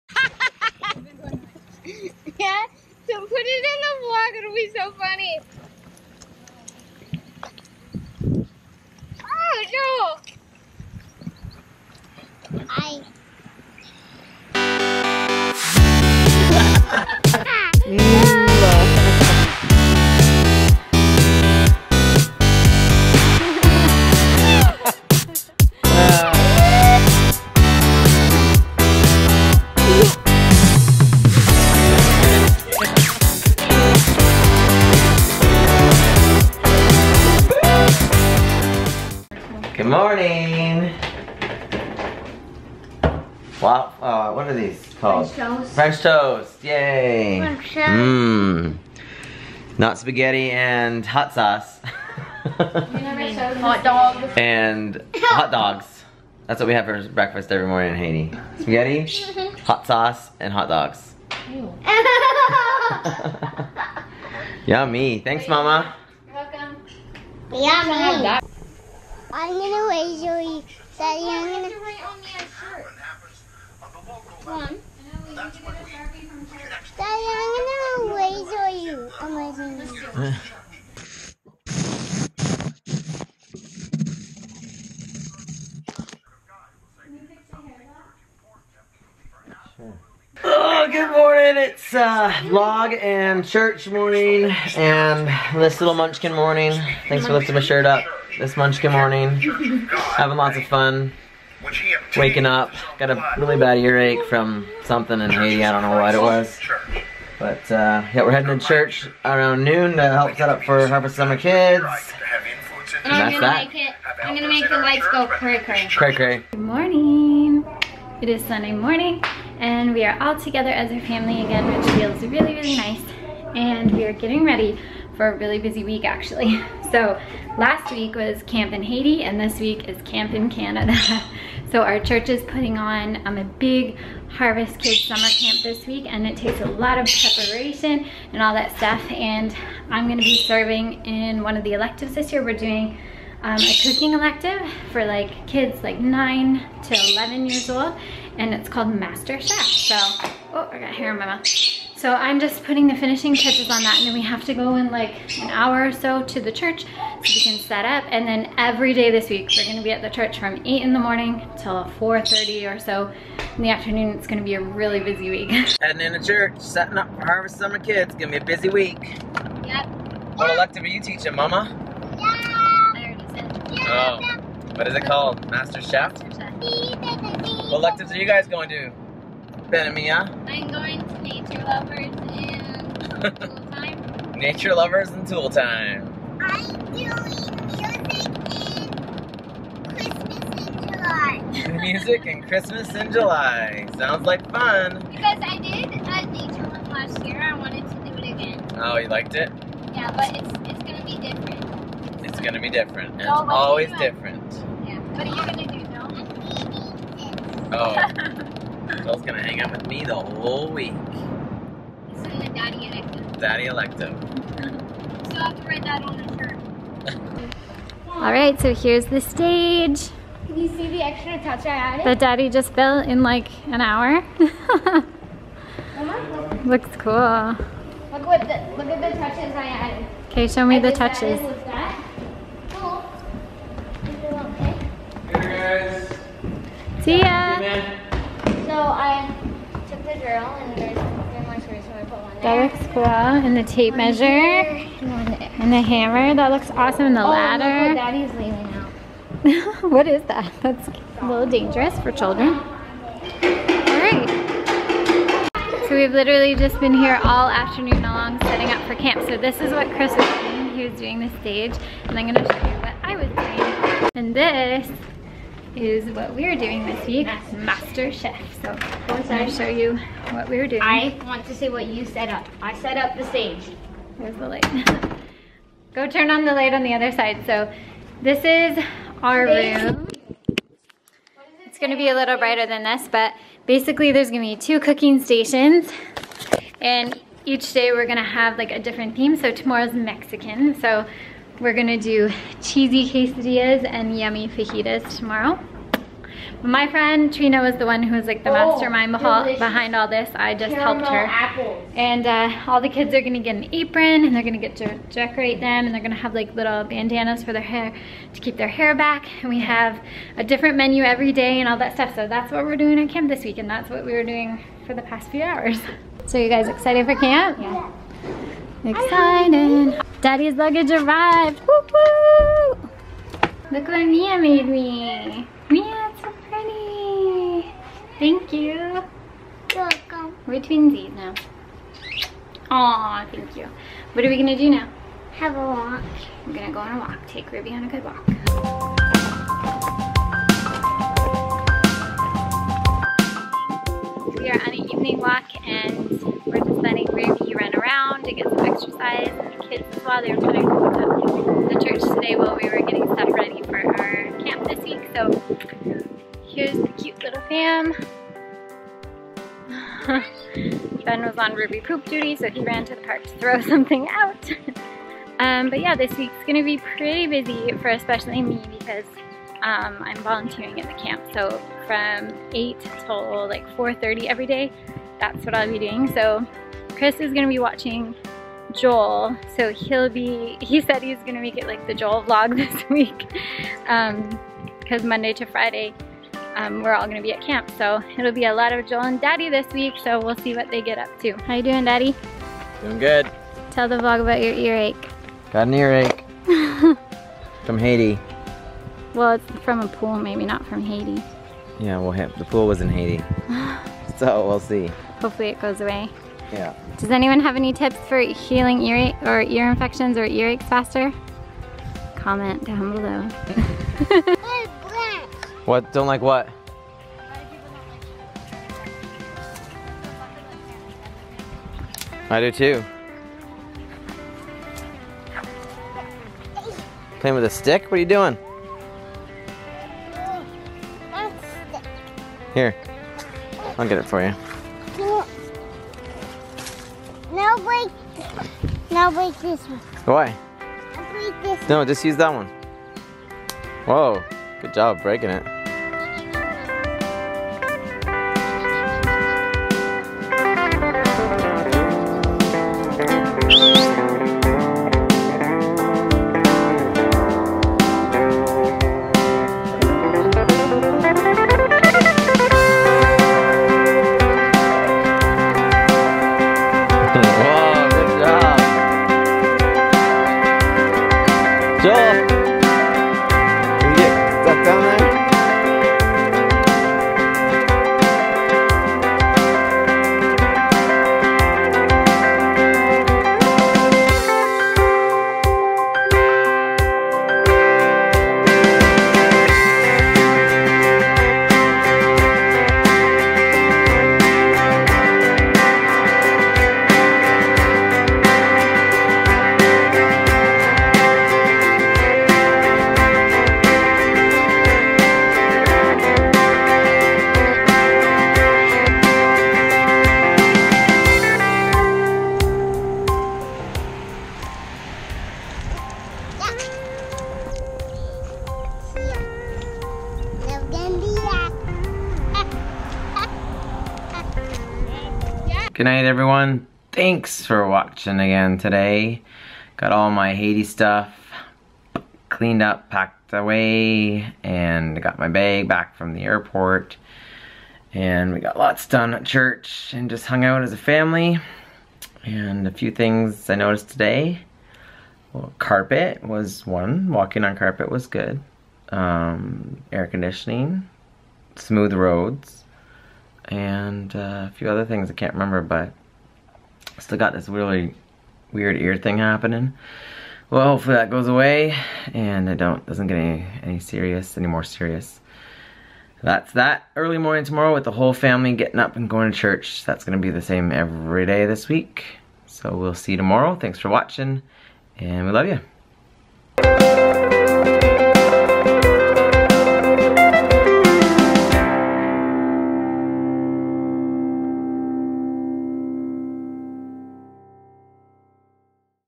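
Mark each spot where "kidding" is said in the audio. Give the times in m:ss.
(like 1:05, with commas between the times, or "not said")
not said.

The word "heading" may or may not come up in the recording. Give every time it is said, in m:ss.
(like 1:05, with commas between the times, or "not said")
1:48, 2:45.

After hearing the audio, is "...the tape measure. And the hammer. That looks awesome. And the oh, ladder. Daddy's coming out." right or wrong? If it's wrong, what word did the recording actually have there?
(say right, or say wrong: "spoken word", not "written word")
wrong: "leaning", not "coming".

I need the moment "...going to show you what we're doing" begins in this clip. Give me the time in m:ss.
4:29.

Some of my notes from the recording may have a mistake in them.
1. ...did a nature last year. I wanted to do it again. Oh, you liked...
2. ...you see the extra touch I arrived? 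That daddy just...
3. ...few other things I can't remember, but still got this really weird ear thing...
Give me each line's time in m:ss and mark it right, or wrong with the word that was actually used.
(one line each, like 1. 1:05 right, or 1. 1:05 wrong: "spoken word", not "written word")
1. 3:15 right
2. 3:40 wrong: "added", not "arrived"
3. 9:14 right.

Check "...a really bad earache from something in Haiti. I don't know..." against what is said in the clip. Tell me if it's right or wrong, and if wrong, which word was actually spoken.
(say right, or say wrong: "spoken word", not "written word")
right.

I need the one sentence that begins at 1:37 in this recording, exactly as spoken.
Thanks for lifting my shirt up this Munchkin morning.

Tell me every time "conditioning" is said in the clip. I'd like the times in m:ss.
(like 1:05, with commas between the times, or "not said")
9:10.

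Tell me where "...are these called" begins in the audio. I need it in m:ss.
0:44.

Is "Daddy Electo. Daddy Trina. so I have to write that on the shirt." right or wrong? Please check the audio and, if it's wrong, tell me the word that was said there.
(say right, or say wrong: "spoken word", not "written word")
wrong: "Electo", not "Trina".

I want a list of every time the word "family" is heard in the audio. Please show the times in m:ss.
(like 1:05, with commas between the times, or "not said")
2:01, 9:00, 9:28.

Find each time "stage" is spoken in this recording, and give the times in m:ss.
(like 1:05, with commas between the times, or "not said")
3:39, 4:21, 4:33.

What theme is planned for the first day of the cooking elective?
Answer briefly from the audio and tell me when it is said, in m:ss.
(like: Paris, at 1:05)
Mexican, at 4:49.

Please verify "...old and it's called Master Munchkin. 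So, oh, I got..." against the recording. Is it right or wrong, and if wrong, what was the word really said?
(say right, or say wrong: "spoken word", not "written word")
wrong: "Chef", not "Munchkin".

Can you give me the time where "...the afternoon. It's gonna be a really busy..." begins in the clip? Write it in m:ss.
2:43.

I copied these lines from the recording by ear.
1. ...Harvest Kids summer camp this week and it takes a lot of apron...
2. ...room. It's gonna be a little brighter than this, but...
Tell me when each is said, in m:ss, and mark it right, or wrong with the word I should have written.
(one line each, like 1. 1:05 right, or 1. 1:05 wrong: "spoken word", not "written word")
1. 2:14 wrong: "preparation", not "apron"
2. 4:39 right.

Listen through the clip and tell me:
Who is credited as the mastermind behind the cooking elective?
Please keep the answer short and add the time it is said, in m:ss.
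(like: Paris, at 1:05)
Trina, at 4:57.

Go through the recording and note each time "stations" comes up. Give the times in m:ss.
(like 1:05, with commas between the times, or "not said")
4:45.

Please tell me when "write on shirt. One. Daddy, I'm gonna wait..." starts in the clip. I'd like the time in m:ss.
1:11.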